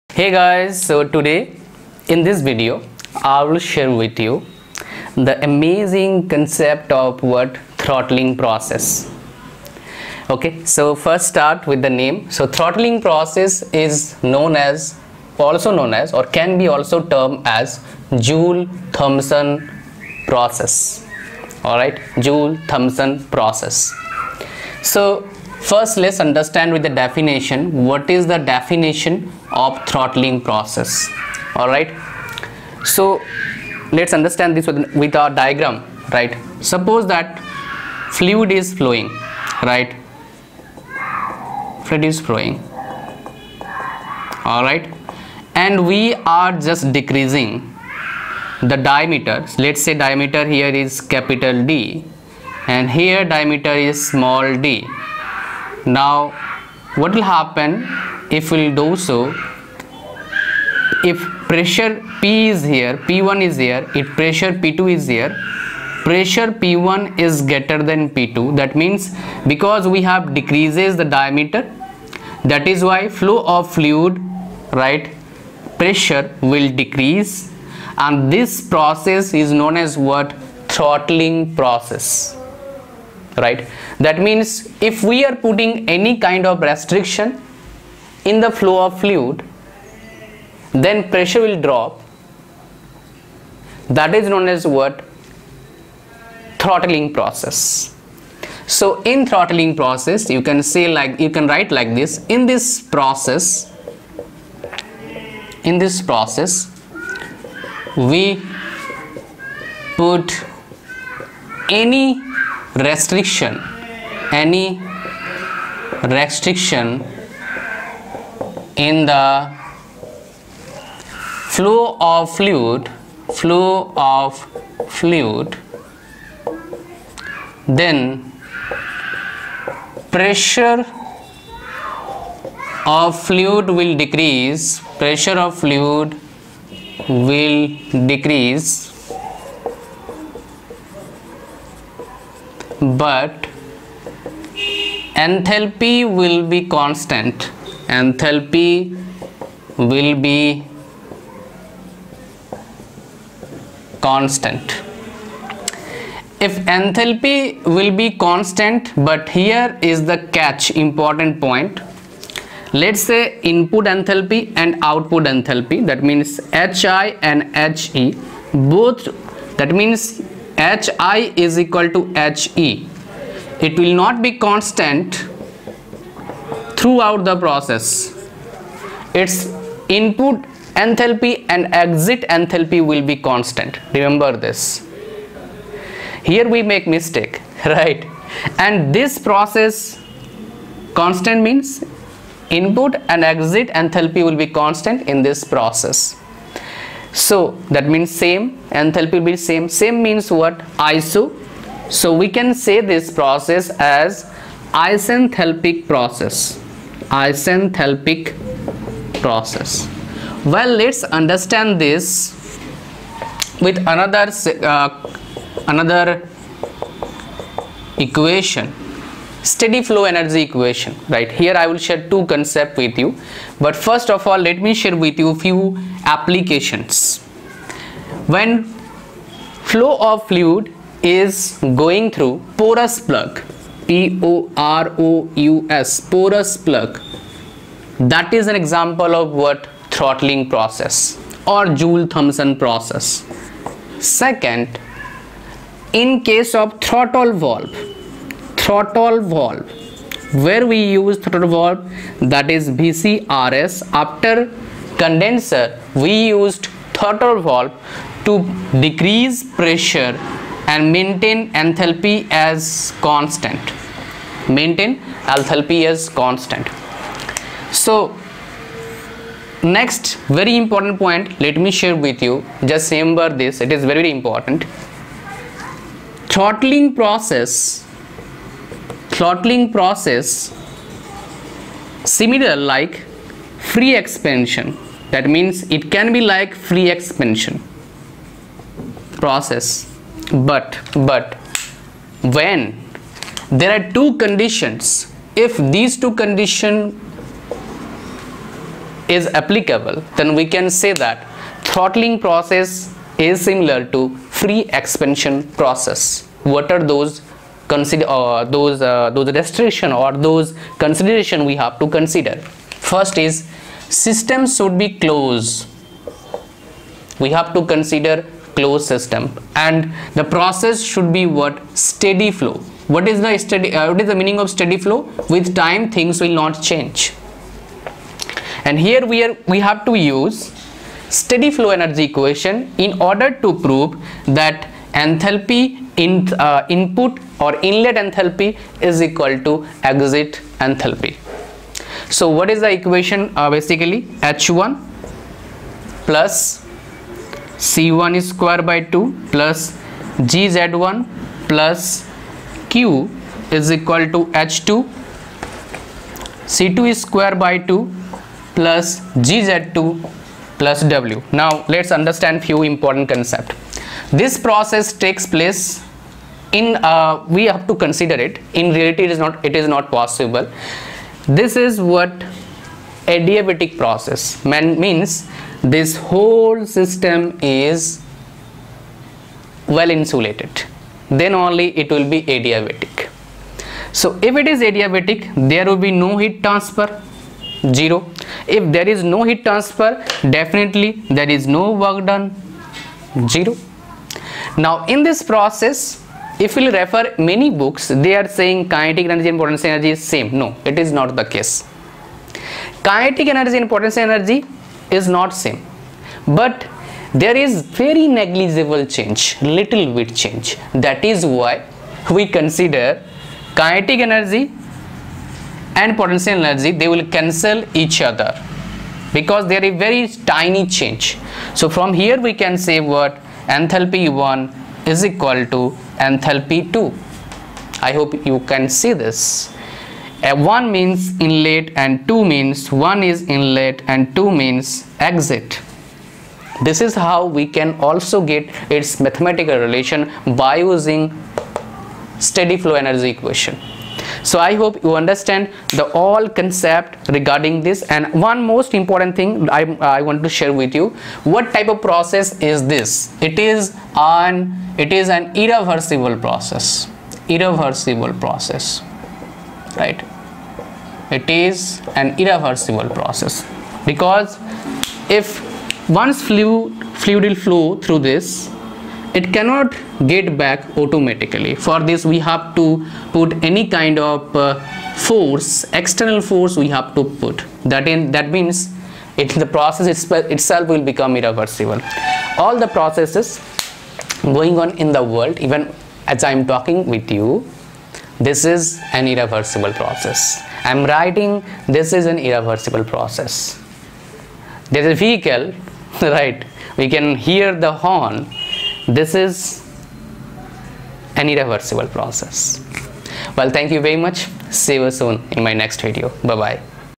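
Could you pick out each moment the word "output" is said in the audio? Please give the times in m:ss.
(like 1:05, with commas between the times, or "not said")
2:44.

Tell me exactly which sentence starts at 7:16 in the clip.
This is how we can also get its mathematical relation by using steady flow energy equation.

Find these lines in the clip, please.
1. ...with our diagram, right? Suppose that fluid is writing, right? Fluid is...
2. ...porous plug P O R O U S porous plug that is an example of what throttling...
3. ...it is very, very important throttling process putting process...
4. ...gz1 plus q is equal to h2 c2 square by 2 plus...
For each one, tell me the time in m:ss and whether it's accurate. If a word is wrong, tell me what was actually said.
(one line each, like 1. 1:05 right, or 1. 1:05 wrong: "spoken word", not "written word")
1. 0:34 wrong: "flowing", not "writing"
2. 3:52 right
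3. 4:33 wrong: "throttling", not "putting"
4. 5:50 right.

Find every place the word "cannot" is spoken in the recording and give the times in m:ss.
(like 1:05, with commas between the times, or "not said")
7:49.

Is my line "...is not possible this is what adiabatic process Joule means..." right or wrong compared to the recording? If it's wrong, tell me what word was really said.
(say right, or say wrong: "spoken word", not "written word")
wrong: "Man", not "Joule".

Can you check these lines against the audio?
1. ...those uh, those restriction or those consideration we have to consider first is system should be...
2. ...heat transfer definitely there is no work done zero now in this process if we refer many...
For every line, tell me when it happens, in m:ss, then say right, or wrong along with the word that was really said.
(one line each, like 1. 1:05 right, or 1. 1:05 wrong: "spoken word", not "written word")
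1. 5:08 right
2. 6:29 right.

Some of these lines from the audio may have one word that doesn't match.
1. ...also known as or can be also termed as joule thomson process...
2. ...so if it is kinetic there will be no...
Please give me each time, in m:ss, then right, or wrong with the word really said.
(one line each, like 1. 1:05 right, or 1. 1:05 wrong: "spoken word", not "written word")
1. 0:15 right
2. 6:23 wrong: "adiabatic", not "kinetic".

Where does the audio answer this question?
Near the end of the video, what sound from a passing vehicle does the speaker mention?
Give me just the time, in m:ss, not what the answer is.
8:17.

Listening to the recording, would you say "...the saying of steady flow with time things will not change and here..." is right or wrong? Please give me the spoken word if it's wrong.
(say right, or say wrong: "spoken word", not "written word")
wrong: "meaning", not "saying".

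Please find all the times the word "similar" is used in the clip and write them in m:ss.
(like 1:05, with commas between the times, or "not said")
4:42, 5:03.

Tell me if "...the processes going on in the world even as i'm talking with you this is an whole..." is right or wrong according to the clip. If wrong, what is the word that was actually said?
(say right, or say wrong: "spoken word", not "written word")
wrong: "irreversible", not "whole".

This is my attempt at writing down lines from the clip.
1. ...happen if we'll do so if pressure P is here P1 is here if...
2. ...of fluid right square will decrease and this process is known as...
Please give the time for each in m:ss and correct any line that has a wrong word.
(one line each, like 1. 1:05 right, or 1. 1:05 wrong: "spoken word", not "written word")
1. 0:57 right
2. 1:13 wrong: "pressure", not "square".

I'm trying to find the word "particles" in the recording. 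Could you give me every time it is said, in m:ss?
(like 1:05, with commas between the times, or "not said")
not said.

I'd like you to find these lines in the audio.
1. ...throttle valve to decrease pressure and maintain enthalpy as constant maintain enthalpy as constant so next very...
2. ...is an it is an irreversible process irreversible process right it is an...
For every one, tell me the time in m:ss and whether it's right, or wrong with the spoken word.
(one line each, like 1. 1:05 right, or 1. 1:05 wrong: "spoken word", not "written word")
1. 4:16 right
2. 7:33 right.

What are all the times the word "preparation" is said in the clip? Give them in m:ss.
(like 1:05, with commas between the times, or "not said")
not said.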